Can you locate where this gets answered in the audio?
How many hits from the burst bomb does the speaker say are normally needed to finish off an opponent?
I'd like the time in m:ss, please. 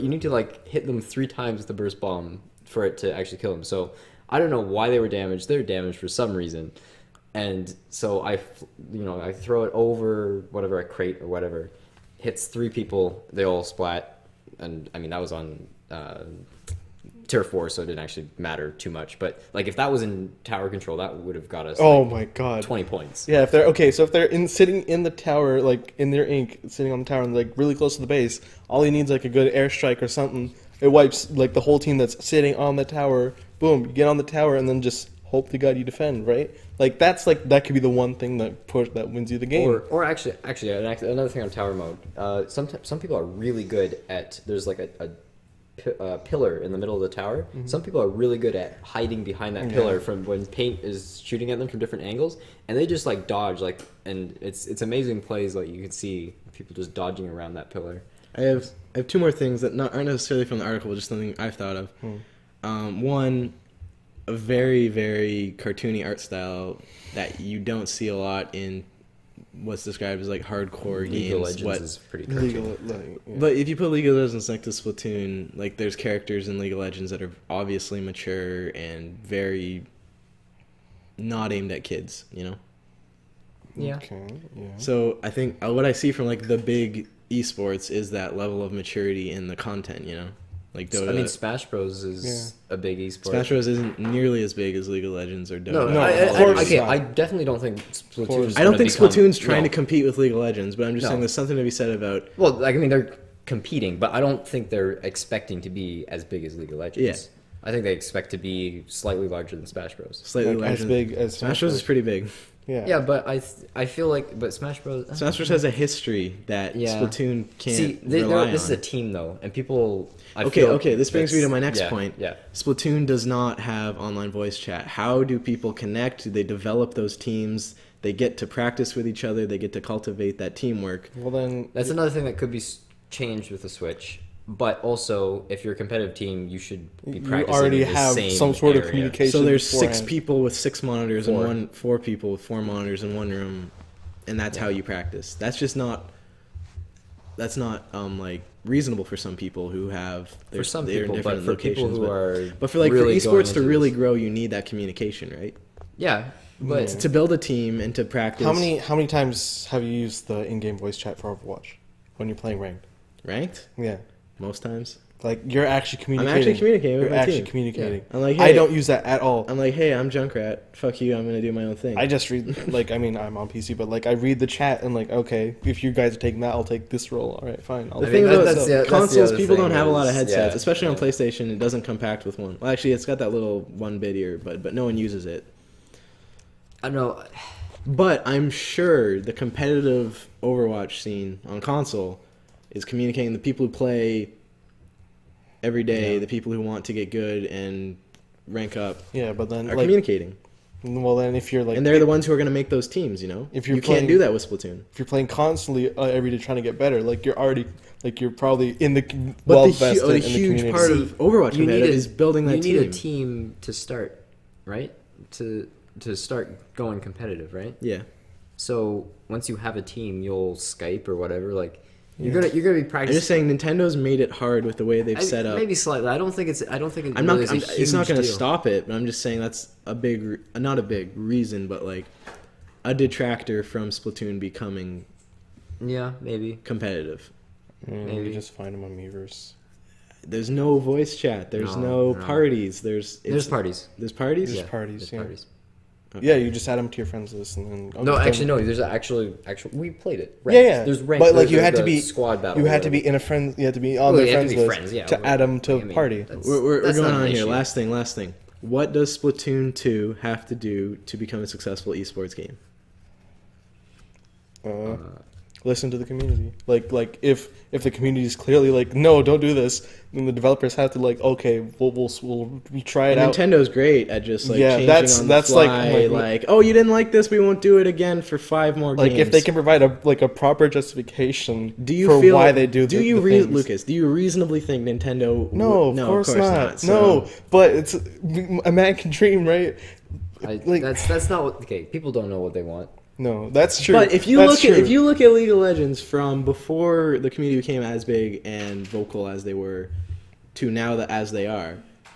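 0:01.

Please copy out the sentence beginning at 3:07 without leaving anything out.
But I'm sure the competitive Overwatch scene on console is communicating the people who play every day, yeah.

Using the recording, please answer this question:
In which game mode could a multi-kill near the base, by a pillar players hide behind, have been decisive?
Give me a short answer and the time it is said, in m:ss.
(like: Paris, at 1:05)
Tower Control, at 0:20.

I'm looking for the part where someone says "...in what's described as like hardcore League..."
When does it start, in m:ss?
1:08.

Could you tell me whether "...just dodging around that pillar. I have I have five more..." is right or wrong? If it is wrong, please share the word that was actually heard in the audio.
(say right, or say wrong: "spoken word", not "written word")
wrong: "two", not "five".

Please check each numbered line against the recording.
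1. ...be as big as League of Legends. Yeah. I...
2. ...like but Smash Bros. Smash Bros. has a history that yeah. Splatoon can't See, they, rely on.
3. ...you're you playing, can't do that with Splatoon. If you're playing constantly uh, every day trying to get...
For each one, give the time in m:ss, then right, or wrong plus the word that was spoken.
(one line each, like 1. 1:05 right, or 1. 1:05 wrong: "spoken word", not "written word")
1. 1:45 right
2. 1:54 right
3. 3:23 right.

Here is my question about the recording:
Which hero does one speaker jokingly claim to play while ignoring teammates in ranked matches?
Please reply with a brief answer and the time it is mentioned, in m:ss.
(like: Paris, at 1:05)
Junkrat, at 2:50.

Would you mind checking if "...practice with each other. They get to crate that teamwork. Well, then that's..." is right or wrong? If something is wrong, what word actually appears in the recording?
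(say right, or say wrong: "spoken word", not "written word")
wrong: "cultivate", not "crate".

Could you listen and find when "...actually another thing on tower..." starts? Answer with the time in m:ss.
0:40.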